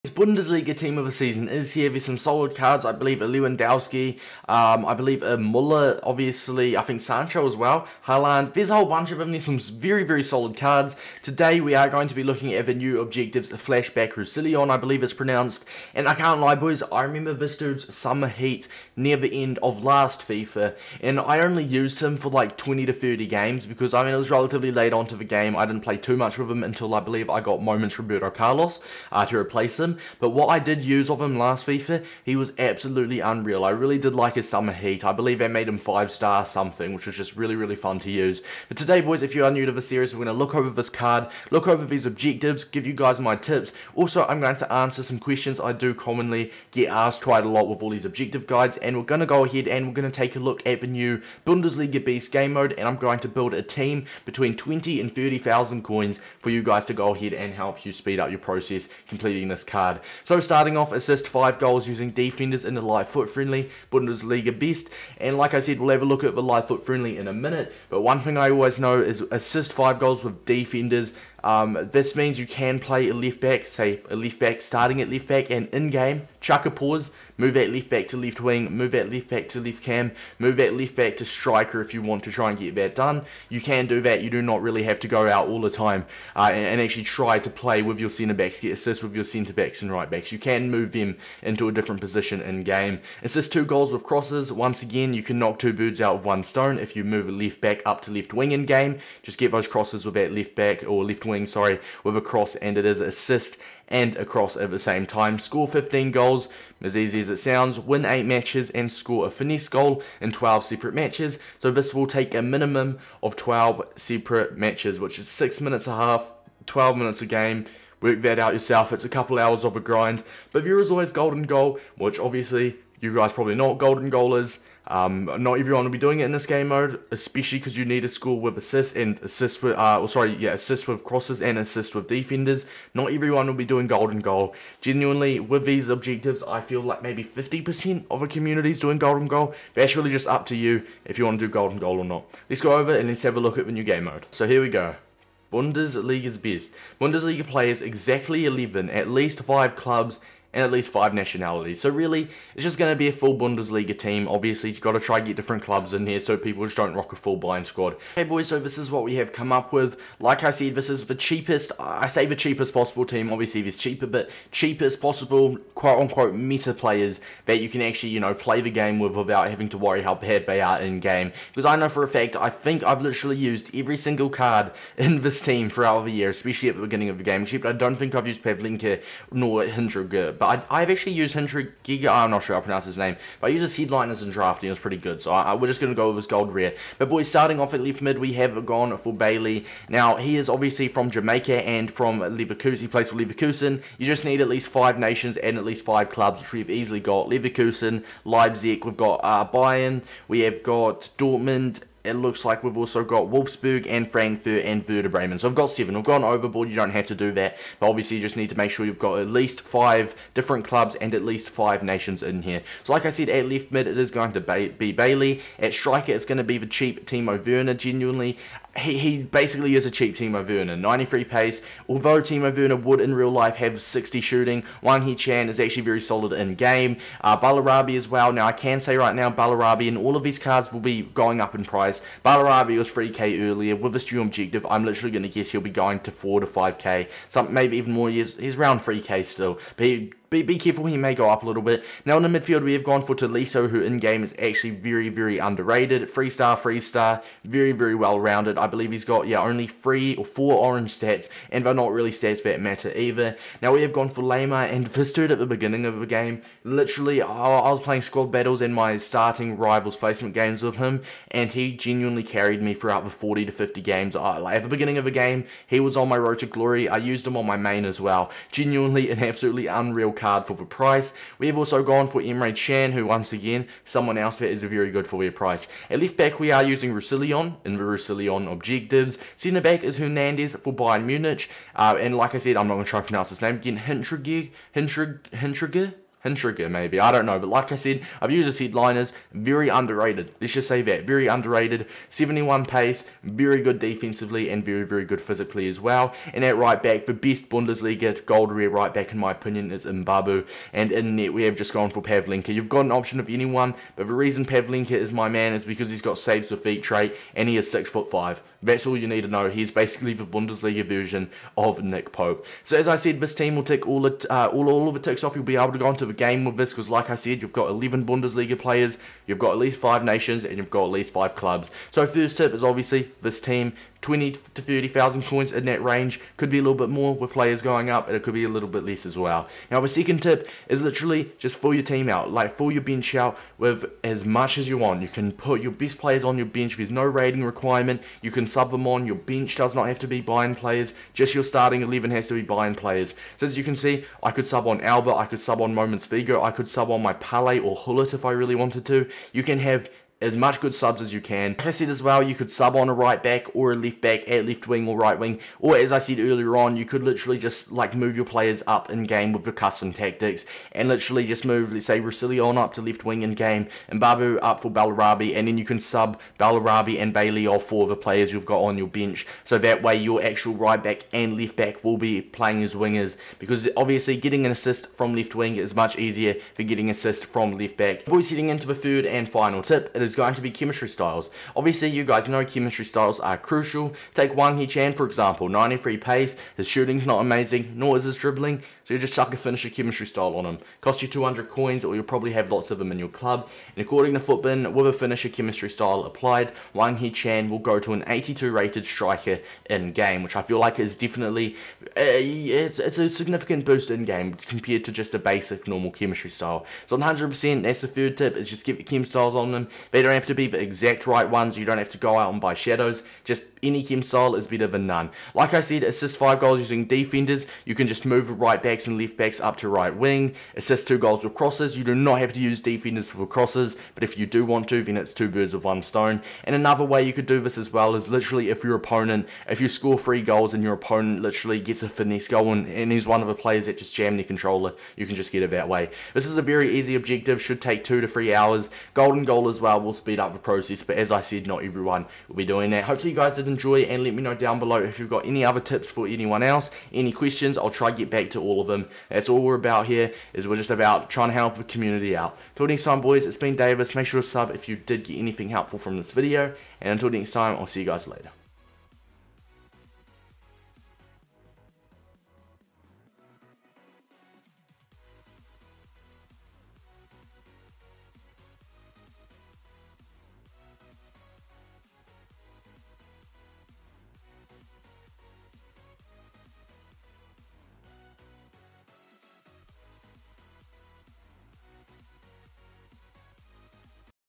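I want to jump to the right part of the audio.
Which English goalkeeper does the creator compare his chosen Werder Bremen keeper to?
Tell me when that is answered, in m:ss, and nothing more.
5:11.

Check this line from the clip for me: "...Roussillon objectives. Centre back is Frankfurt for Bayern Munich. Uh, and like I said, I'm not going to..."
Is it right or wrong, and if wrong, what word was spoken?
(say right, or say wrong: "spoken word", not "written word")
wrong: "Hernandez", not "Frankfurt".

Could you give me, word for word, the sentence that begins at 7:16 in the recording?
This is a very easy objective, should take 2 to 3 hours.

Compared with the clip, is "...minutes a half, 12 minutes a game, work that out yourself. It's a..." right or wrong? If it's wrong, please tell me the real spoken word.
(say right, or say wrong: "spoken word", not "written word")
right.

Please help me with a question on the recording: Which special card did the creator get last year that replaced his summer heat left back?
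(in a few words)
Moments Roberto Carlos.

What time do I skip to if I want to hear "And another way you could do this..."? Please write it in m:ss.
7:06.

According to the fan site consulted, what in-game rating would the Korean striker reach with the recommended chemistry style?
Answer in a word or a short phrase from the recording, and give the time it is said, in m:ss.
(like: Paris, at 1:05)
82, at 6:38.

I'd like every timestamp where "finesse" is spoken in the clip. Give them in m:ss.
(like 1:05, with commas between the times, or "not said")
1:49, 7:11.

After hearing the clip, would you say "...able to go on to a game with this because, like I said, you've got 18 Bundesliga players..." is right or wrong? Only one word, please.
wrong.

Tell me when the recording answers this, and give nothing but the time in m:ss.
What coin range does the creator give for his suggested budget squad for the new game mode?
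0:54.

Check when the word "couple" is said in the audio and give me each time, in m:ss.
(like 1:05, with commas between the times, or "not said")
1:59.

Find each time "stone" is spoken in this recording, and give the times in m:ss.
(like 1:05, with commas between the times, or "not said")
1:36, 7:05.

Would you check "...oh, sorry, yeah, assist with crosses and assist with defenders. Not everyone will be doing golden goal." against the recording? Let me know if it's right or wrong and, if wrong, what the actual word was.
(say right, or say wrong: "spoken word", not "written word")
right.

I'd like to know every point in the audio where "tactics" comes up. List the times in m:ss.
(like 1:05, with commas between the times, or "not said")
5:59.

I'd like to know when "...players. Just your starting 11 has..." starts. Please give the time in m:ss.
5:40.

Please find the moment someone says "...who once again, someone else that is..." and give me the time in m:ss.
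4:32.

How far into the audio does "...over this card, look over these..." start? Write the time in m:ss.
0:40.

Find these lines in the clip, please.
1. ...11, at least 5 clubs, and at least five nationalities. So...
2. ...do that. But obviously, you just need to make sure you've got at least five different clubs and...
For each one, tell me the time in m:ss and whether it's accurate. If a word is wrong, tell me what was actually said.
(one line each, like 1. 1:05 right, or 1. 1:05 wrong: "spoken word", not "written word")
1. 2:28 right
2. 3:27 right.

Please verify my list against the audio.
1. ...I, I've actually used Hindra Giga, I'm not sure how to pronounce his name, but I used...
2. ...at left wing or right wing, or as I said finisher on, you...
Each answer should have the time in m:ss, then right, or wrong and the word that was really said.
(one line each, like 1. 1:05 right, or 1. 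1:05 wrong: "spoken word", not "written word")
1. 3:00 right
2. 5:54 wrong: "earlier", not "finisher".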